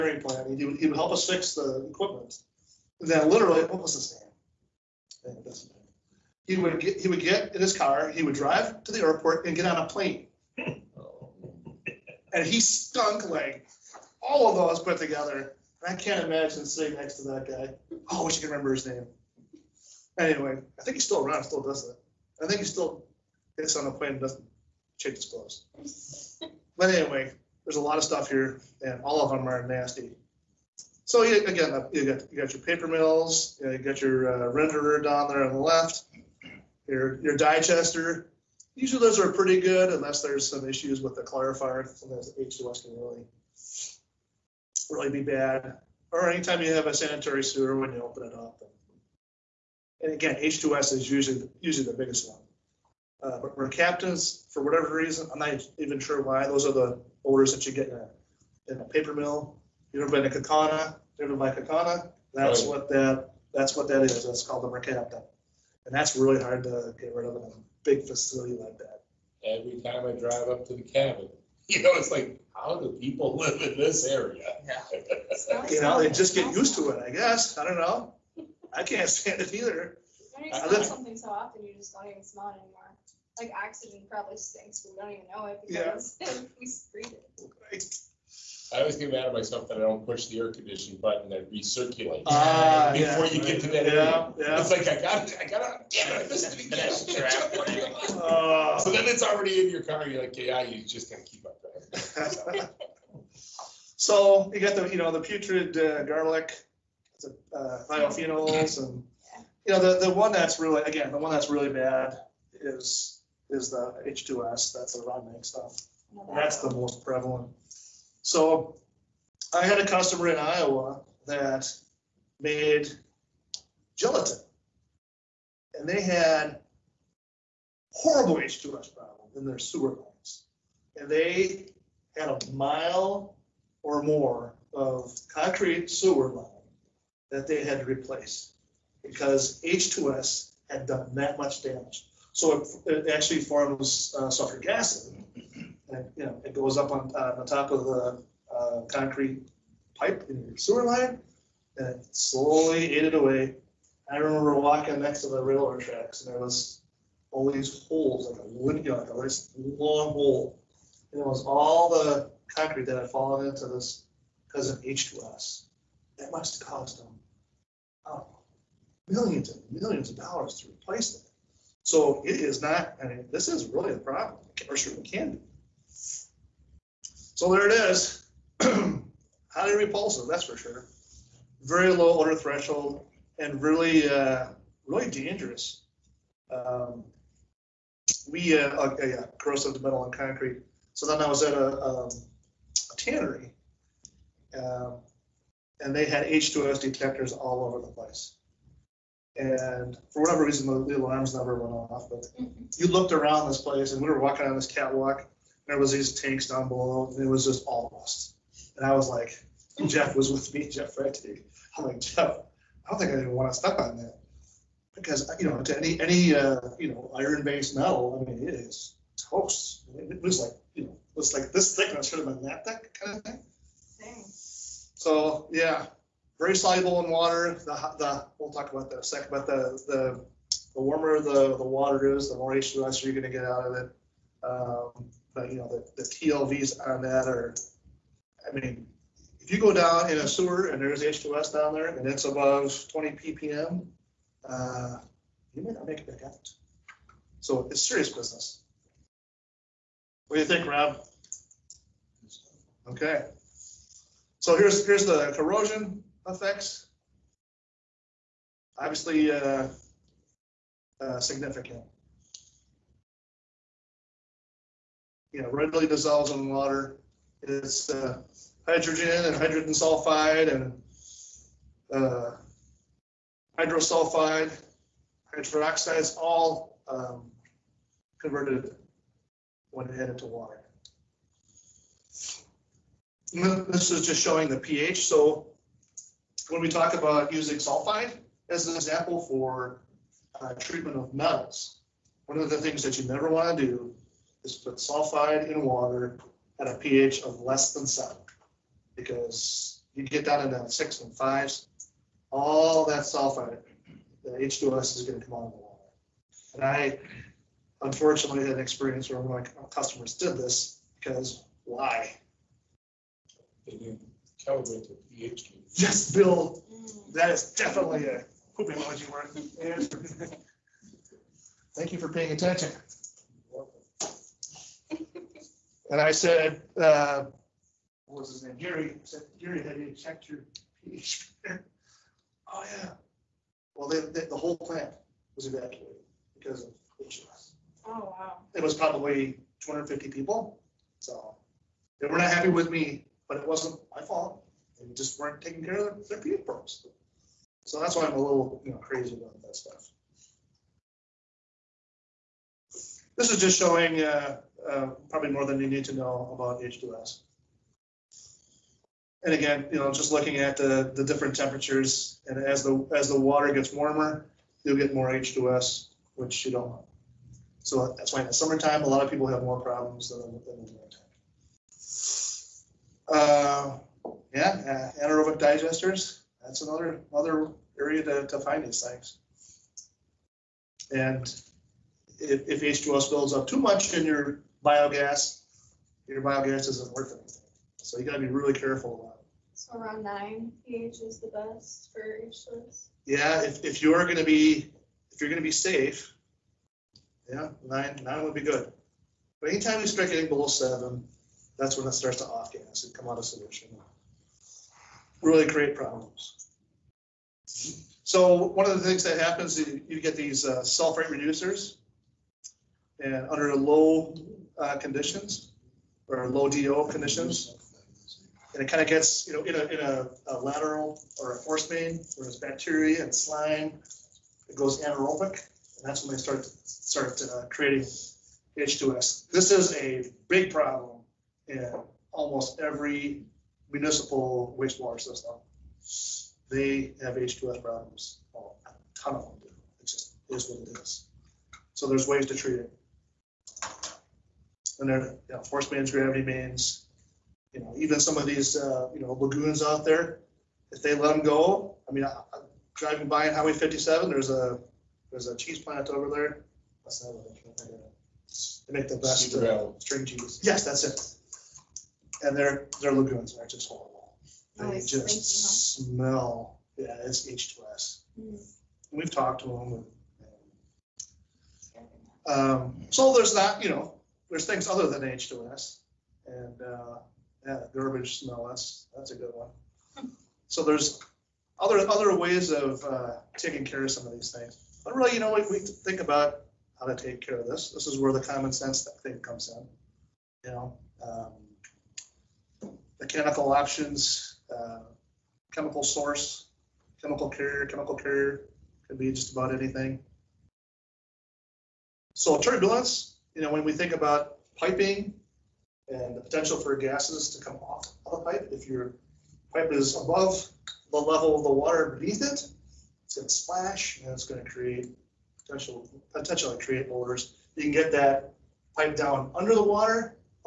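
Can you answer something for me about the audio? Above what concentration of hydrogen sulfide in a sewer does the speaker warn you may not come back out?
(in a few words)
20 ppm.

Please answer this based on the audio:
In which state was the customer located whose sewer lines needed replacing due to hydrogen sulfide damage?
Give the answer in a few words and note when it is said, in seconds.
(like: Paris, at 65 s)
Iowa, at 120 s.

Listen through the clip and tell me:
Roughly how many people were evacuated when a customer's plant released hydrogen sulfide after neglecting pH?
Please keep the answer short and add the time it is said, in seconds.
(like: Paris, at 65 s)
250, at 339 s.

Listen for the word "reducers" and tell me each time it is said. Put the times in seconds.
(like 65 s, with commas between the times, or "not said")
411 s.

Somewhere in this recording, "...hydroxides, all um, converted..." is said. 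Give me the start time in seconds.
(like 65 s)
275 s.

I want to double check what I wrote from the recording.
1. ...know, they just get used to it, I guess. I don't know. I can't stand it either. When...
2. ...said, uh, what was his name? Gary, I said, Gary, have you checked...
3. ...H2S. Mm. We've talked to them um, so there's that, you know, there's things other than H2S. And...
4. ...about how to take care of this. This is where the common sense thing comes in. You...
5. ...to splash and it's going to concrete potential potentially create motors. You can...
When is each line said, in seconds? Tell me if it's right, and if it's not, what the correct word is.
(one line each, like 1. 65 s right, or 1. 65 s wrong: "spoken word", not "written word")
1. 75 s right
2. 326 s right
3. 467 s right
4. 486 s right
5. 513 s wrong: "create", not "concrete".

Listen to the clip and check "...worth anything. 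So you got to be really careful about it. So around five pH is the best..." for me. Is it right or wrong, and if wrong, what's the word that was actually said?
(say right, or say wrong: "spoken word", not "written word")
wrong: "nine", not "five".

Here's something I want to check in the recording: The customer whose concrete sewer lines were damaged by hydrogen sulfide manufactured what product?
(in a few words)
gelatin.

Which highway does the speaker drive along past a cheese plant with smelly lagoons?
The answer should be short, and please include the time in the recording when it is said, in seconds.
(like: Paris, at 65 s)
Highway 57, at 453 s.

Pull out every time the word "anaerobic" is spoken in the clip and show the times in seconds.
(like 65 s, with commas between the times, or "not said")
375 s, 424 s.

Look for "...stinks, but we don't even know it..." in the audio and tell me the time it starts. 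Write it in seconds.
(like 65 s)
84 s.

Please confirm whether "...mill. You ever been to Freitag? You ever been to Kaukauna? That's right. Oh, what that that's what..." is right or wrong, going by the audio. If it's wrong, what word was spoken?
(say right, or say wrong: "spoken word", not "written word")
wrong: "Kaukauna", not "Freitag".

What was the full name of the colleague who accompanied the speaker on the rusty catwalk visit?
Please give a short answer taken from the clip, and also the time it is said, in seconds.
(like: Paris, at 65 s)
Jeff Freitag, at 210 s.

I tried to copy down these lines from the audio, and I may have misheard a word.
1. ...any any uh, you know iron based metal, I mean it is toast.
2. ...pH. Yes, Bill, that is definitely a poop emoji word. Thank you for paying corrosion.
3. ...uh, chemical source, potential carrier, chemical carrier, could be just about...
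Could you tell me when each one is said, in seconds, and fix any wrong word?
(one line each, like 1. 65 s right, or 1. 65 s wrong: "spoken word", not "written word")
1. 215 s right
2. 315 s wrong: "attention", not "corrosion"
3. 494 s wrong: "chemical", not "potential".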